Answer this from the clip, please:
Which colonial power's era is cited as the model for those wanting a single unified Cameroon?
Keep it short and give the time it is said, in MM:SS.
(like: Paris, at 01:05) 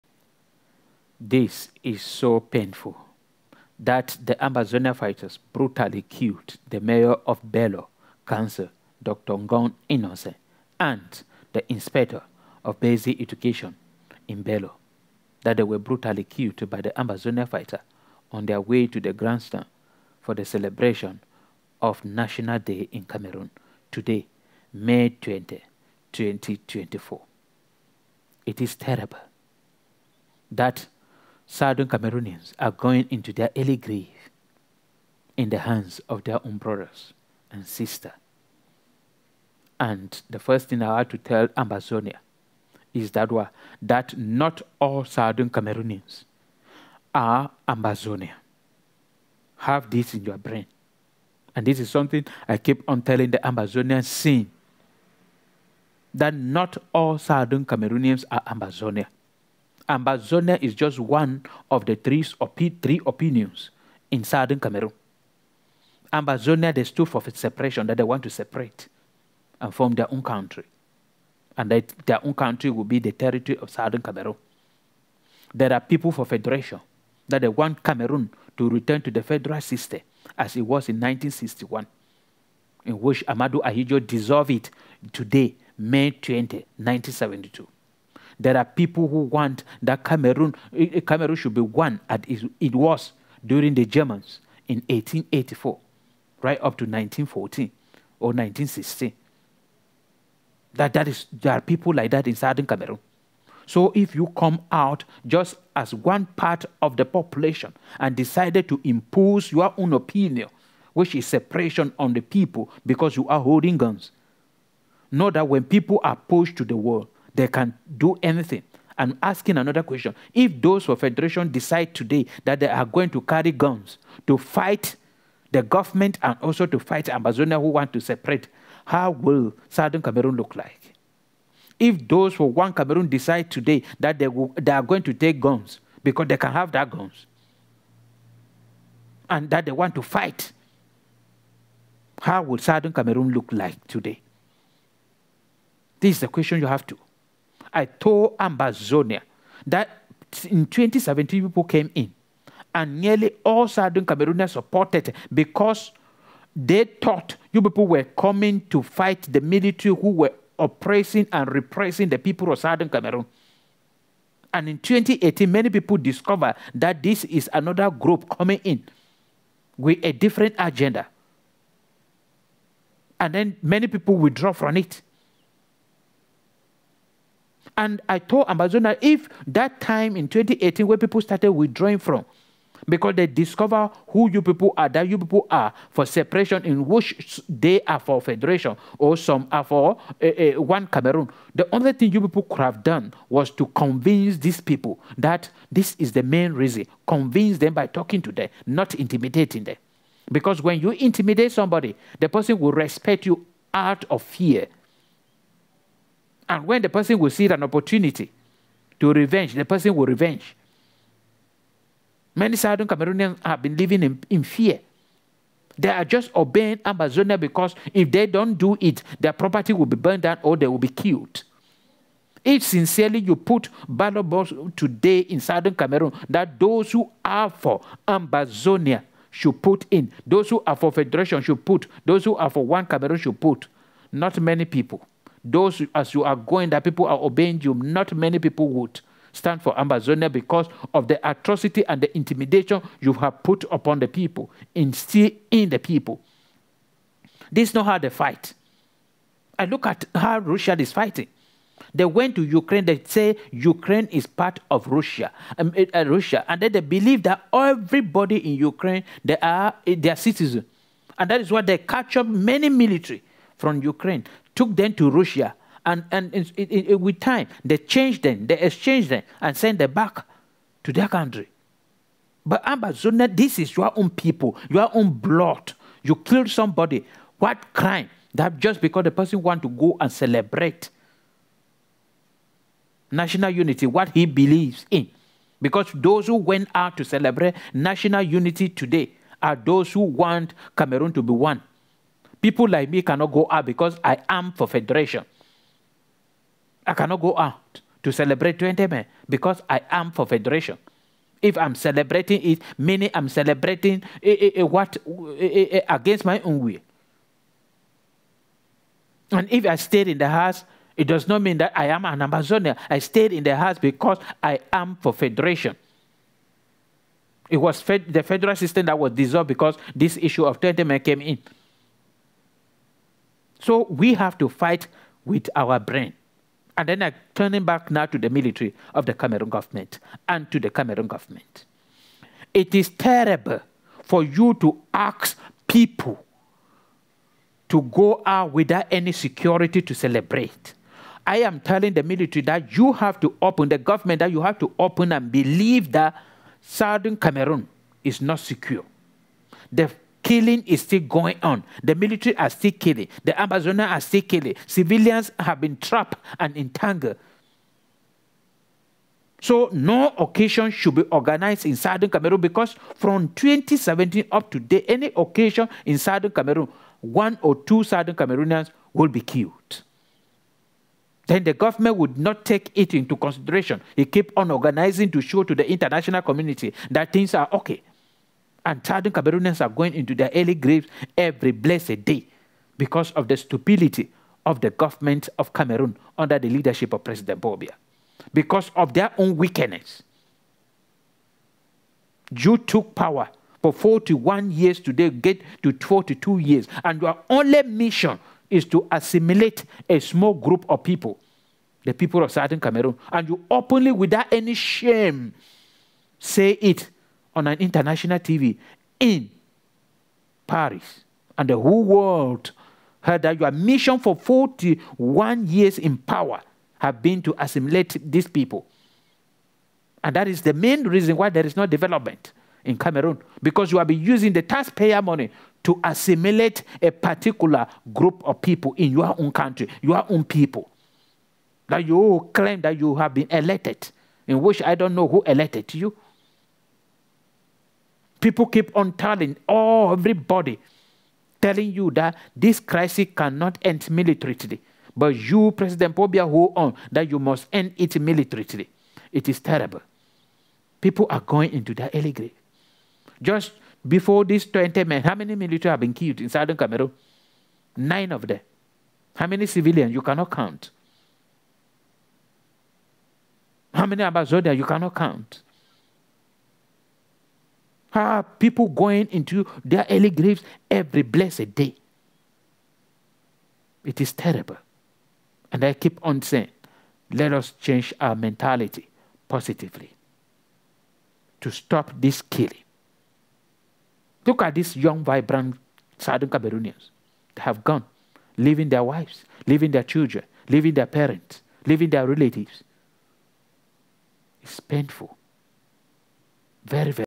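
the Germans, at 01:33.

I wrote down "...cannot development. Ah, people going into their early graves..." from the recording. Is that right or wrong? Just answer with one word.
wrong.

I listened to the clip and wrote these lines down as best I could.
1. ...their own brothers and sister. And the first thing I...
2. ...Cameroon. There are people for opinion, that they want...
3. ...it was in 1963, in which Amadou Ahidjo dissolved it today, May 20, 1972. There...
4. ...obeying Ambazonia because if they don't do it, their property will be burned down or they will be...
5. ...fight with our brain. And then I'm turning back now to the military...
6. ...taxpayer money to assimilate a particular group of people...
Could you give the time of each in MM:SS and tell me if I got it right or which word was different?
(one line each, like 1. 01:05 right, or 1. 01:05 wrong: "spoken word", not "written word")
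1. 00:36 right
2. 01:14 wrong: "federation", not "opinion"
3. 01:20 wrong: "1961", not "1963"
4. 03:36 right
5. 05:24 right
6. 07:04 right.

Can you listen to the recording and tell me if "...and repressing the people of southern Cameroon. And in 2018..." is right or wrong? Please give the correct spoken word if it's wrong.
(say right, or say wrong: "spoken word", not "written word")
right.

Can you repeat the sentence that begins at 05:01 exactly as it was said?
If I'm celebrating it, meaning I'm celebrating eh, eh, what eh, against my own will.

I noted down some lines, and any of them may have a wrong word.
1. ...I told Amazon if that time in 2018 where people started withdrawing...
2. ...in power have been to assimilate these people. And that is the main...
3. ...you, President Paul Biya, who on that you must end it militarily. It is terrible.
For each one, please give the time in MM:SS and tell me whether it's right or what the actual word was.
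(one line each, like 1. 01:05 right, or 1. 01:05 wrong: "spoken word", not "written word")
1. 02:58 right
2. 06:55 right
3. 07:25 right.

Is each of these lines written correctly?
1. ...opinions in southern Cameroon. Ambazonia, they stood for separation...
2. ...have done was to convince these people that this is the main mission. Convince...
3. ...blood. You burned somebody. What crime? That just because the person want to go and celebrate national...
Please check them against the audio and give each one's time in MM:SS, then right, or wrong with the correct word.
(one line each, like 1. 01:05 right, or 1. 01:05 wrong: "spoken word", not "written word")
1. 01:03 right
2. 03:12 wrong: "reason", not "mission"
3. 04:35 wrong: "killed", not "burned".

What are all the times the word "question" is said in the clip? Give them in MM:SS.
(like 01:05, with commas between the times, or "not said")
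01:59, 02:26.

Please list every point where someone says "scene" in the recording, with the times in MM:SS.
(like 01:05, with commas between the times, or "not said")
00:54.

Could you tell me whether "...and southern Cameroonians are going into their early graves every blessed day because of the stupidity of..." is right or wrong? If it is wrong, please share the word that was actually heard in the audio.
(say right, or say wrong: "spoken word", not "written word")
right.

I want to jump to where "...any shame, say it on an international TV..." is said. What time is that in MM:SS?
06:44.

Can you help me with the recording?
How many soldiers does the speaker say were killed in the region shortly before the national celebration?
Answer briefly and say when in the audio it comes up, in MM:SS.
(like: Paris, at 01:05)
9, at 07:37.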